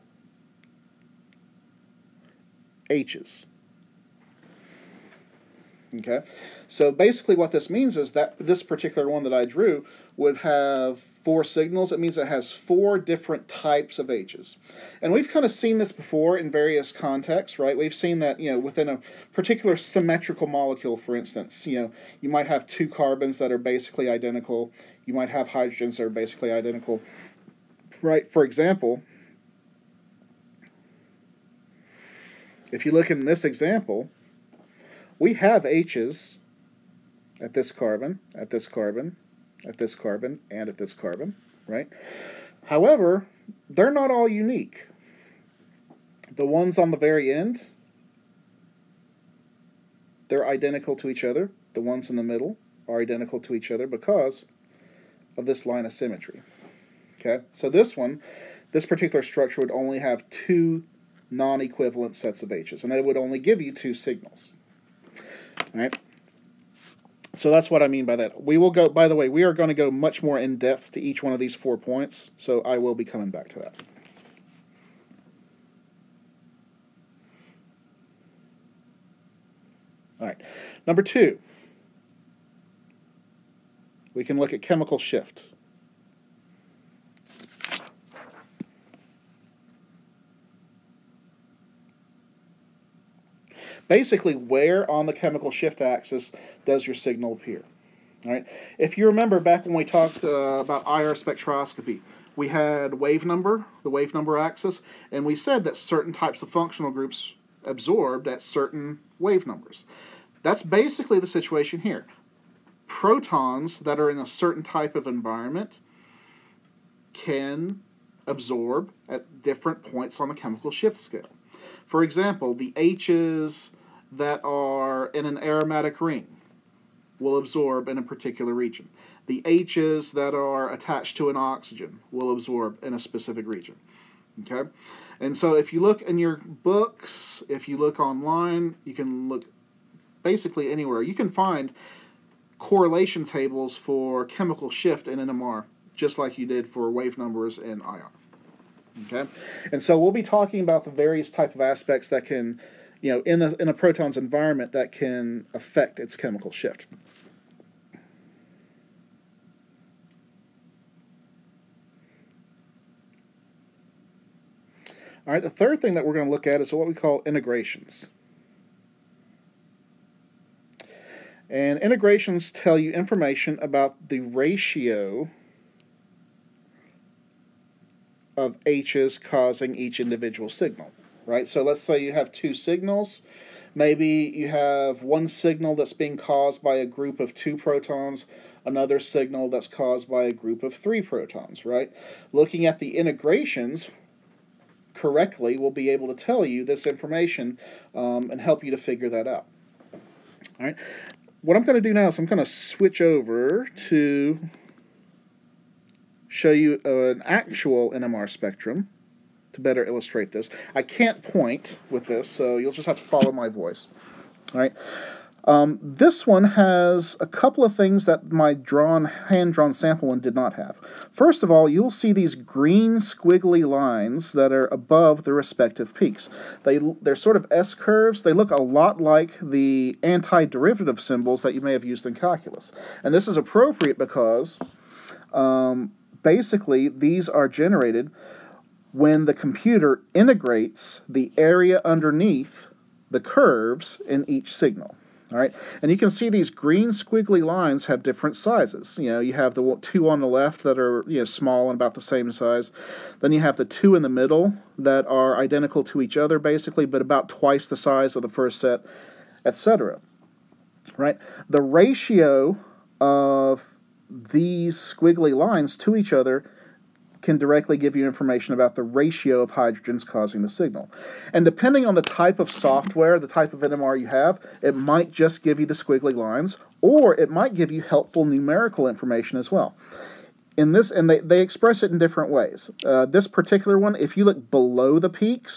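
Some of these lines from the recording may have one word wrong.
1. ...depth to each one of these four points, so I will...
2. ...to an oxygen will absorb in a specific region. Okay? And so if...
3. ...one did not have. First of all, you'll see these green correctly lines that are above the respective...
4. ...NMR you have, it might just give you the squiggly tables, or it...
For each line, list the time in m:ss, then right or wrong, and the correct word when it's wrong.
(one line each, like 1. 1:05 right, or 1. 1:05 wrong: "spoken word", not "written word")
1. 1:10 right
2. 2:11 right
3. 3:40 wrong: "squiggly", not "correctly"
4. 4:33 wrong: "lines", not "tables".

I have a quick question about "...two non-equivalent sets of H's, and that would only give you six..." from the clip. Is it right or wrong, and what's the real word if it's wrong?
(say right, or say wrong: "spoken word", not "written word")
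wrong: "two", not "six".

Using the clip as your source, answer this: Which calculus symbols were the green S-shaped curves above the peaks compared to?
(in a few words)
antiderivative symbols.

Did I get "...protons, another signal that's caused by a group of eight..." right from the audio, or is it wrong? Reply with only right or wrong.
wrong.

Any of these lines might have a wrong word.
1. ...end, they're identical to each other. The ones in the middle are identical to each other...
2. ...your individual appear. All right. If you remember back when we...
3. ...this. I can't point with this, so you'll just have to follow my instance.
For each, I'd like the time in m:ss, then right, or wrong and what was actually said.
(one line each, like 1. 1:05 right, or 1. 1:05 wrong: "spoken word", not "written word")
1. 0:47 right
2. 1:36 wrong: "signal", not "individual"
3. 3:30 wrong: "voice", not "instance".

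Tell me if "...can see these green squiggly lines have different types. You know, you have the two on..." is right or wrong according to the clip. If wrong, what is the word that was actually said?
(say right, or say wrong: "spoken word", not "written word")
wrong: "sizes", not "types".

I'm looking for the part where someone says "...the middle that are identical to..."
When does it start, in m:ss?
4:14.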